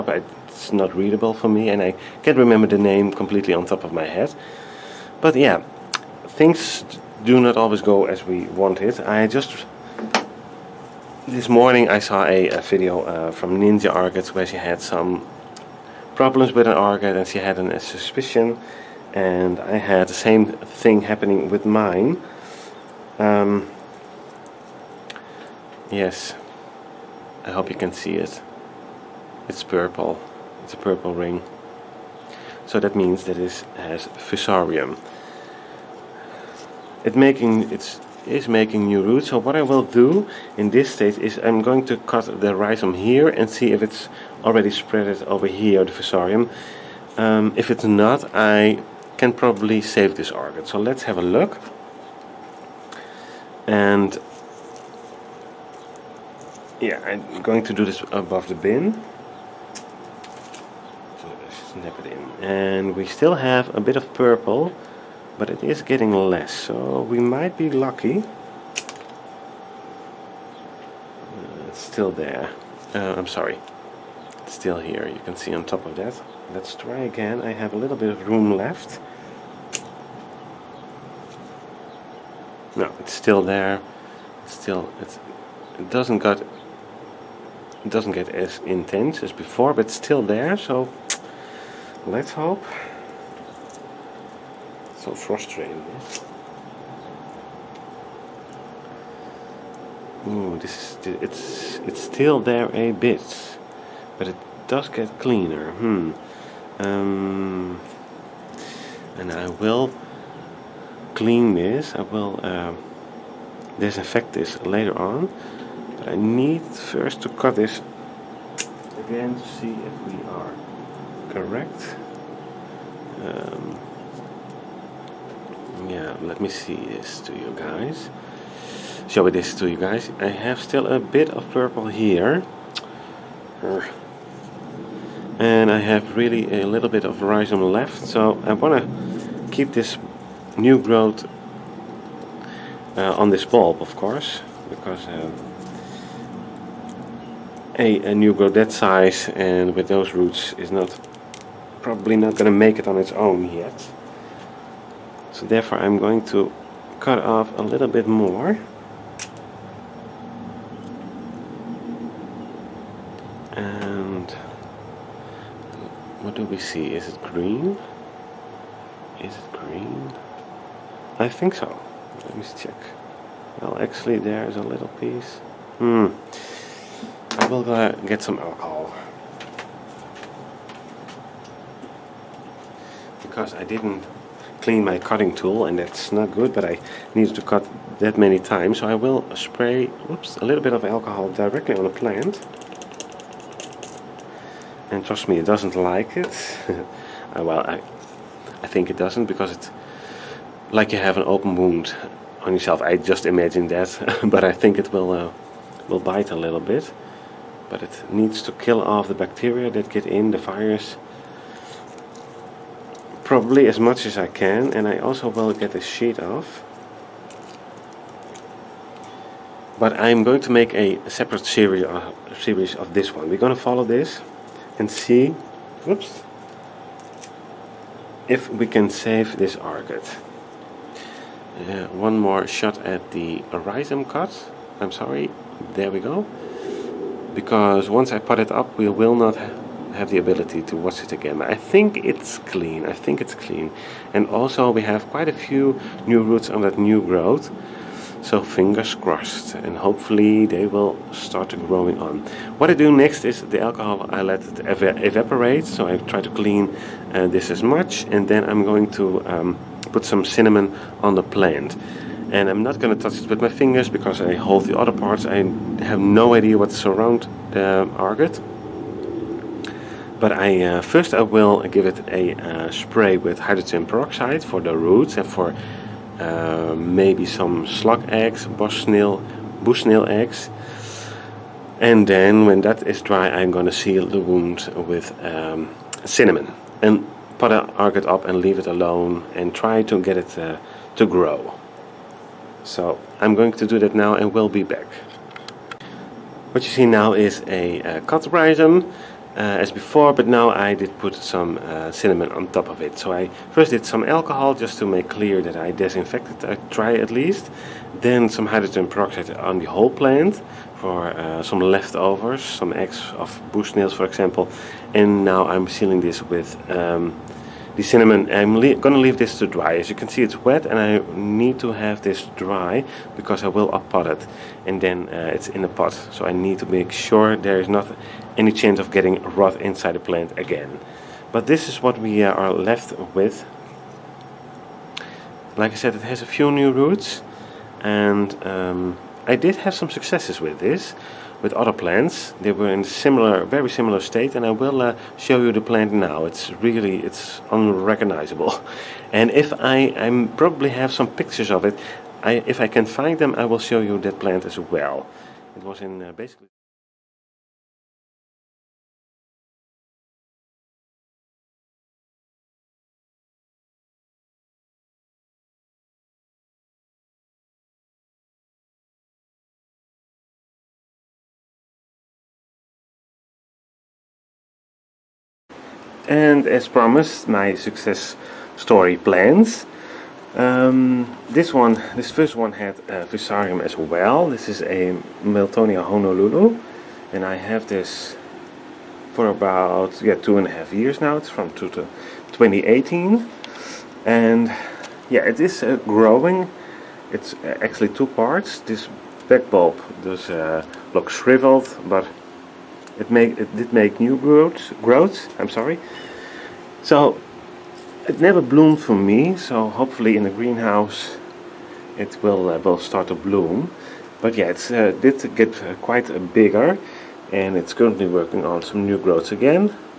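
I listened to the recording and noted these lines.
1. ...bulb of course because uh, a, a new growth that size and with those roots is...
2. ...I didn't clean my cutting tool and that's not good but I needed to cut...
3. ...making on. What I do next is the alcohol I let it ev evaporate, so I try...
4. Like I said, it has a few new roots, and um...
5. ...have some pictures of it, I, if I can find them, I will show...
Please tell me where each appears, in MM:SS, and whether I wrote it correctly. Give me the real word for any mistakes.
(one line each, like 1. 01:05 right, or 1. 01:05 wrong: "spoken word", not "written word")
1. 02:23 right
2. 03:03 right
3. 04:11 wrong: "growing", not "making"
4. 05:35 right
5. 05:50 right.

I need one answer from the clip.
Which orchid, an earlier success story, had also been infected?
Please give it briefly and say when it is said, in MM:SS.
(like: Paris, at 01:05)
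Miltonia Honolulu, at 06:25.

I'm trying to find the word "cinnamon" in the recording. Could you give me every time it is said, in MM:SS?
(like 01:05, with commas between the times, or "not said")
04:20, 04:46, 05:01, 05:17.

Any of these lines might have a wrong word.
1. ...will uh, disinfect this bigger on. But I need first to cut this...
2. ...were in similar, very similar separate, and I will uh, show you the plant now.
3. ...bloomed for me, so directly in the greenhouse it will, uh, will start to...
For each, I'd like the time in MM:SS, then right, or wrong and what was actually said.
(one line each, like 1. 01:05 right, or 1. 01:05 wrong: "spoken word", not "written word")
1. 01:52 wrong: "later", not "bigger"
2. 05:42 wrong: "state", not "separate"
3. 06:48 wrong: "hopefully", not "directly".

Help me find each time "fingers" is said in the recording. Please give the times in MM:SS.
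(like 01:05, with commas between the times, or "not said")
04:08, 04:23.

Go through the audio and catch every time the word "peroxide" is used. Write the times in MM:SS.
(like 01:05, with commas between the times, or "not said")
04:33, 05:08.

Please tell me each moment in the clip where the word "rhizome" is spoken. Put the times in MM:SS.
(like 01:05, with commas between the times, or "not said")
00:42, 02:17, 03:53, 04:58.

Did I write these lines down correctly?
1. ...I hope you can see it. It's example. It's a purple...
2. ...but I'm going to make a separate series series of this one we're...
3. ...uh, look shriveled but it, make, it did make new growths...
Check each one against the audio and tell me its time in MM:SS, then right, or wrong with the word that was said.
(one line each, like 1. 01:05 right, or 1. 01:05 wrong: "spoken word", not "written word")
1. 00:27 wrong: "purple", not "example"
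2. 03:39 right
3. 06:40 right.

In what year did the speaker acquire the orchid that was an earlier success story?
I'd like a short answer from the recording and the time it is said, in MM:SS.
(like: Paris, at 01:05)
2018, at 06:31.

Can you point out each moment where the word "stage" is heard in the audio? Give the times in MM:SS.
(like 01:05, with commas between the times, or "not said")
00:40.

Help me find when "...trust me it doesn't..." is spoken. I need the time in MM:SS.
03:15.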